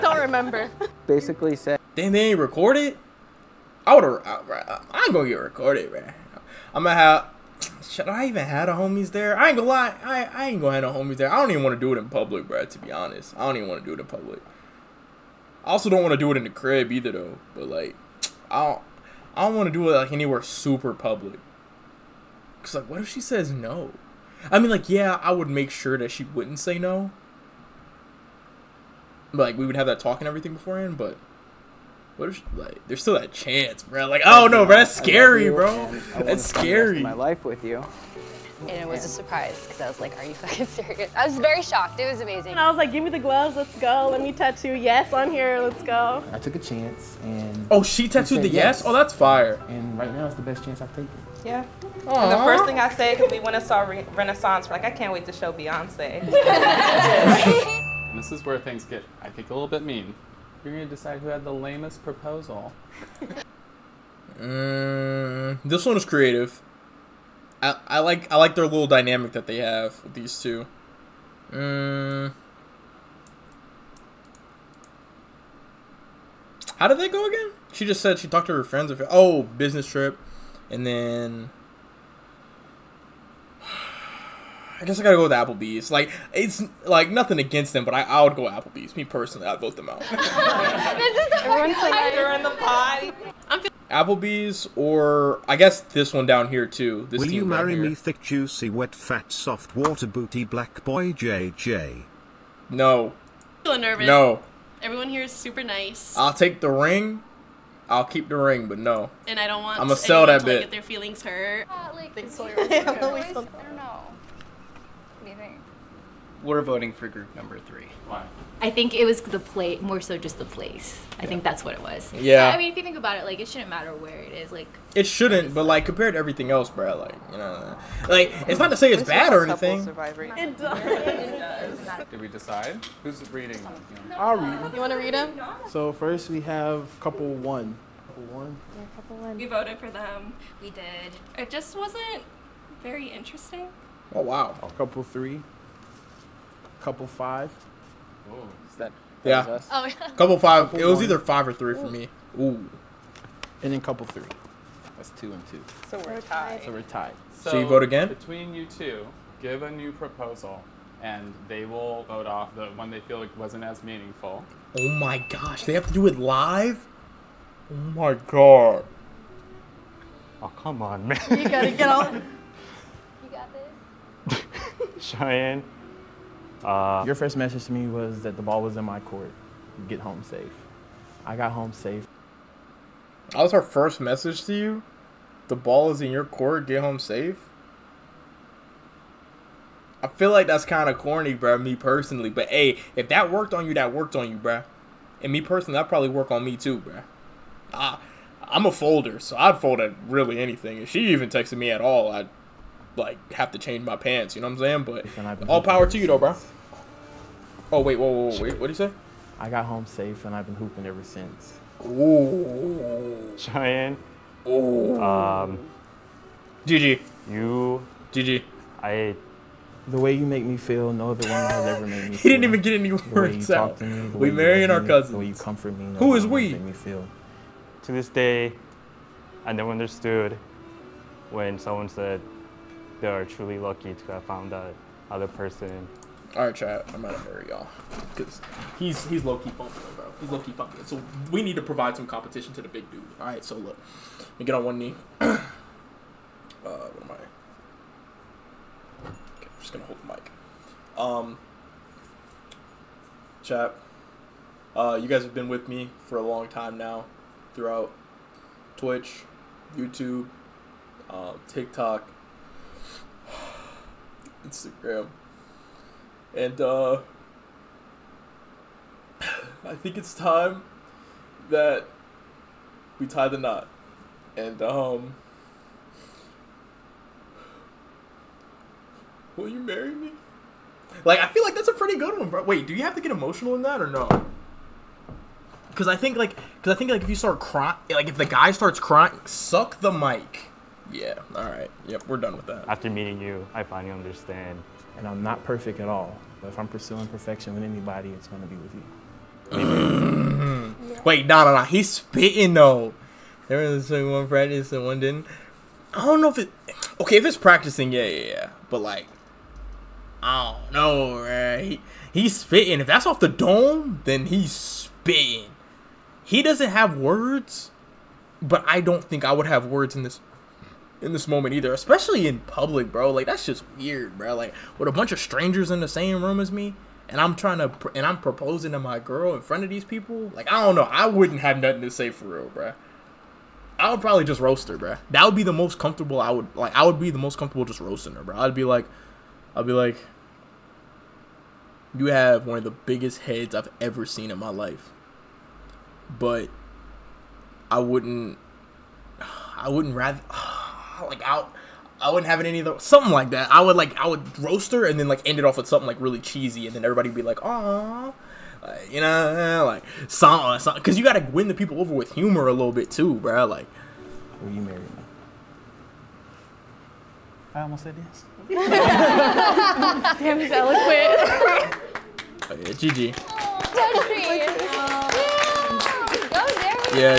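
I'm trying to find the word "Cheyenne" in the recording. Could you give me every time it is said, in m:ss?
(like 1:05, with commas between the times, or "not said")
2:54, 3:33.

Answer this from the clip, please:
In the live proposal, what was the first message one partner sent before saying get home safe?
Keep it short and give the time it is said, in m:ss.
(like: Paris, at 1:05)
The ball was in my court, at 2:58.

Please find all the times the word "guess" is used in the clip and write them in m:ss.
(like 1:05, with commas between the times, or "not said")
1:24, 1:35.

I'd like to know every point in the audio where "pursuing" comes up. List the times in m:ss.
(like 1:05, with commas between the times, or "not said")
4:56.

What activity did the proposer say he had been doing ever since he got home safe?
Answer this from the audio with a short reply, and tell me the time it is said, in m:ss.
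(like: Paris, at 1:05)
Hooping, at 3:30.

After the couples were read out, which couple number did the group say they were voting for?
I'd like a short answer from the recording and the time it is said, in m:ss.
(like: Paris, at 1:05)
Group number three, at 1:57.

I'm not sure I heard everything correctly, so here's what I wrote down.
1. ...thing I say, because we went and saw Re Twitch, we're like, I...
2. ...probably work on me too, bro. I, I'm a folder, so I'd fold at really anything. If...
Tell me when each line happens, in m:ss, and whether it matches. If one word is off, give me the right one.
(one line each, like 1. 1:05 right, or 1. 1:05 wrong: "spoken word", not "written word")
1. 0:52 wrong: "Renaissance", not "Twitch"
2. 3:15 right.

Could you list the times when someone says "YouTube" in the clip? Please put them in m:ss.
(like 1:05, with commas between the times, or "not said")
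4:19.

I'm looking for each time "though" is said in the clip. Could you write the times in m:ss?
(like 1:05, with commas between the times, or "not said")
0:17, 3:26, 5:02.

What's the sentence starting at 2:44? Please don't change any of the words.
Oh my gosh, they have to do it live?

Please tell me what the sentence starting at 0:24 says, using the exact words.
I mean, like, yeah, I would make sure that she wouldn't say no.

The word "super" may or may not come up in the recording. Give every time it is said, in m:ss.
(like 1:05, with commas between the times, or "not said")
0:20, 1:45.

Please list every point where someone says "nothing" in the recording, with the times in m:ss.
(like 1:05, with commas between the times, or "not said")
1:27, 5:31.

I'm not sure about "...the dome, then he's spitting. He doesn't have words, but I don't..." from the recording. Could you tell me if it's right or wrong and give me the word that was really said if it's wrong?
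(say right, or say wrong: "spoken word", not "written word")
right.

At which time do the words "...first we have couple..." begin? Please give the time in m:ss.
2:15.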